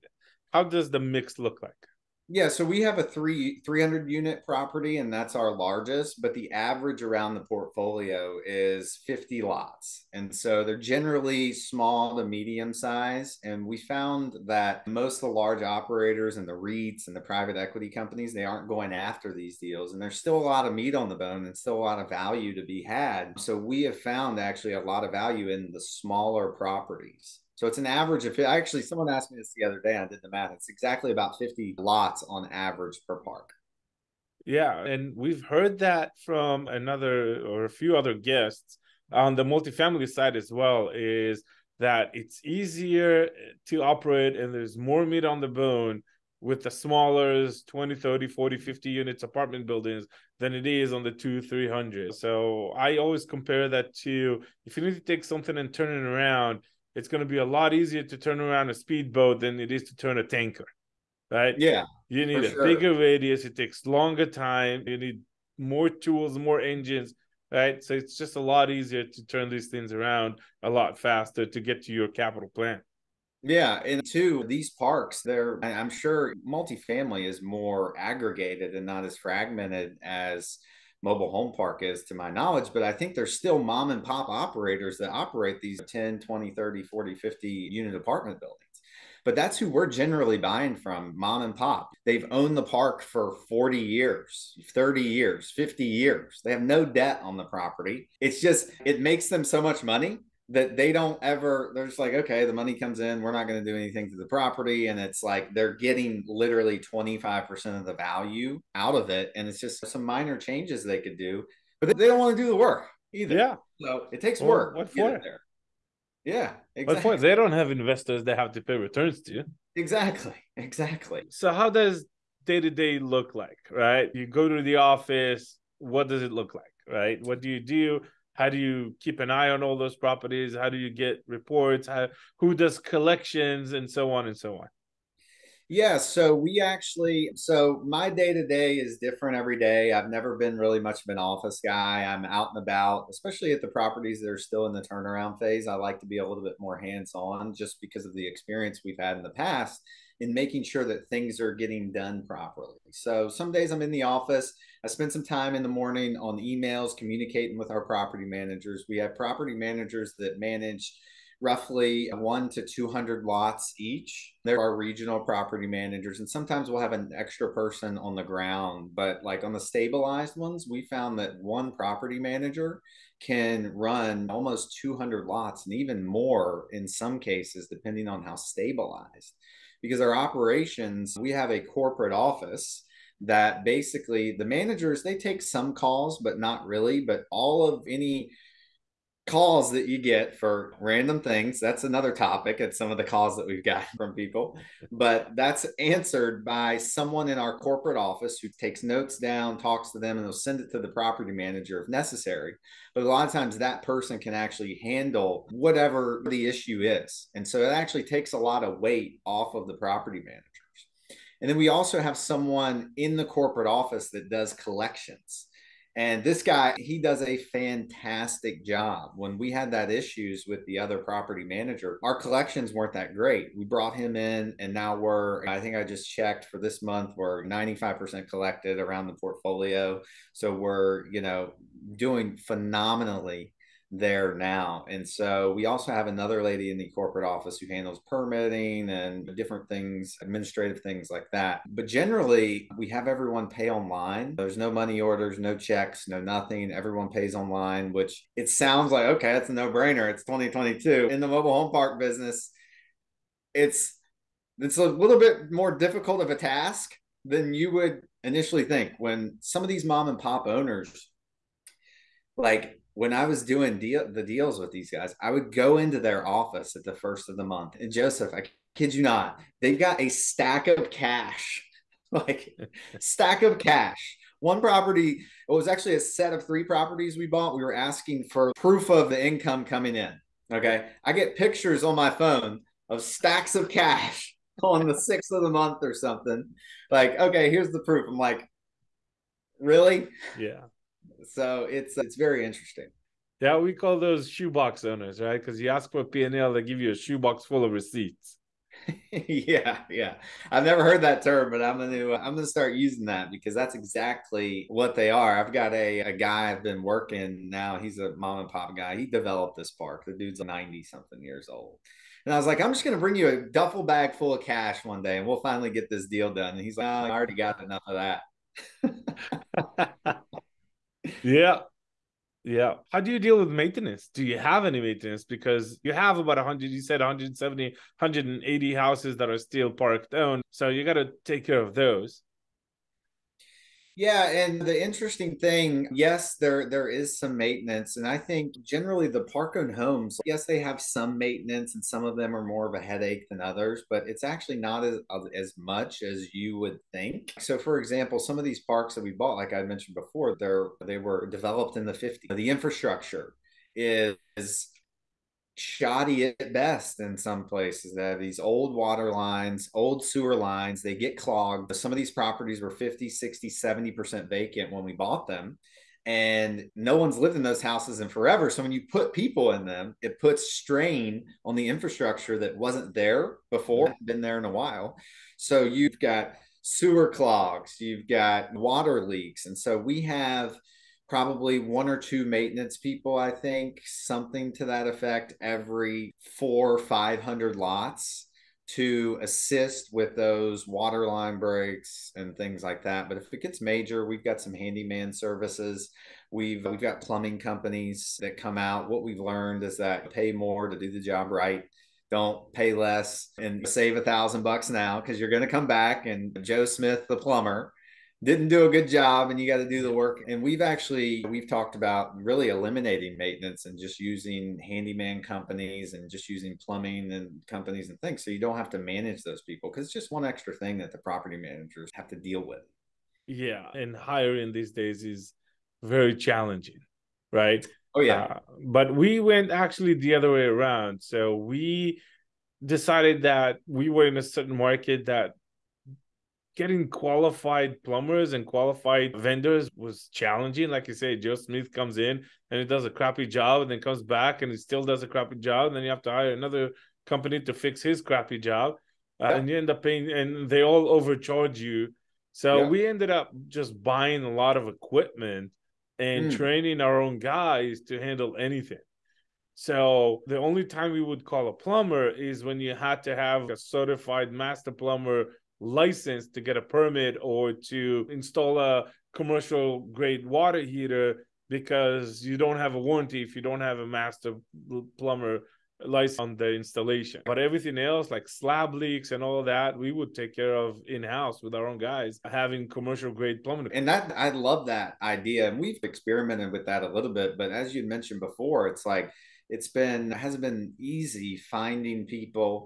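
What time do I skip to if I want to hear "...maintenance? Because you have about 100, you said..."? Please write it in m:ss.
5:24.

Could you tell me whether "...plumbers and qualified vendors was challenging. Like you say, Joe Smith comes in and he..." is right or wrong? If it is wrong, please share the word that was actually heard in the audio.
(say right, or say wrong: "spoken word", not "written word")
right.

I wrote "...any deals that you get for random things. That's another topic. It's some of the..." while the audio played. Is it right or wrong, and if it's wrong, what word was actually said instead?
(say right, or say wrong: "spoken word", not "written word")
wrong: "calls", not "deals".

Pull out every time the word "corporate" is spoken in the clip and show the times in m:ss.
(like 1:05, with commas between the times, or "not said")
3:01, 3:17, 3:33, 3:56.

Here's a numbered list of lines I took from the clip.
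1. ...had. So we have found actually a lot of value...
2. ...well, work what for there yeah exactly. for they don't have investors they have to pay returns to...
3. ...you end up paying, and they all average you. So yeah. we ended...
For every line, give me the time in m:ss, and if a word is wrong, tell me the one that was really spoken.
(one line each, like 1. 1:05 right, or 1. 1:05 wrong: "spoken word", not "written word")
1. 0:22 right
2. 1:54 right
3. 7:29 wrong: "overcharge", not "average".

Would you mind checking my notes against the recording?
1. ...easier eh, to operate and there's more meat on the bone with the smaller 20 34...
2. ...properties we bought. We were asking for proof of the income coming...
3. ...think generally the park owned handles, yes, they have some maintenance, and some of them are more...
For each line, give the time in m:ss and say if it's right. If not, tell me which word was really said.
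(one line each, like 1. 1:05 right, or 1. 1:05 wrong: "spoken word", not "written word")
1. 0:42 wrong: "30", not "34"
2. 4:36 right
3. 5:38 wrong: "homes", not "handles".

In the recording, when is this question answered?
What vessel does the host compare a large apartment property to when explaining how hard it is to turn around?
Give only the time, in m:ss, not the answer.
1:00.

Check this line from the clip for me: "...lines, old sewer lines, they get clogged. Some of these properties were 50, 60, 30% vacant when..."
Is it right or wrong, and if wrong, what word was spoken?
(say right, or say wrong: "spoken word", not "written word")
wrong: "70", not "30".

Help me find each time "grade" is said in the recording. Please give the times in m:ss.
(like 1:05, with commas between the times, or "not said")
7:49, 8:03.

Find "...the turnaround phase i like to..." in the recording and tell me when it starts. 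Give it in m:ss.
2:24.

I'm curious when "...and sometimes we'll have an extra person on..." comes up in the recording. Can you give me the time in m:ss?
2:46.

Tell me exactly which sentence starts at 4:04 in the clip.
There's no money orders, no checks, no nothing.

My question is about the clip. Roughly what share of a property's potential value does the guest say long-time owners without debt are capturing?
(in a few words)
25%.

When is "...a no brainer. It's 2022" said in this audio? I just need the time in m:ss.
4:09.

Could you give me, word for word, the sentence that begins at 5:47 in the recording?
So, for example, some of these parks that we bought, like I mentioned before, they're they were developed in the 50s.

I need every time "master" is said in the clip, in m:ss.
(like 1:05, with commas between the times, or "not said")
7:44, 7:53.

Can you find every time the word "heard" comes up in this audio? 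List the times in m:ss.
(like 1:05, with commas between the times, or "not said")
0:35, 5:00.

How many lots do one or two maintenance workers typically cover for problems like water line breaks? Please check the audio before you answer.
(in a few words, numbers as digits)
400 or 500 lots.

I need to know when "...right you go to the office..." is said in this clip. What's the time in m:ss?
2:03.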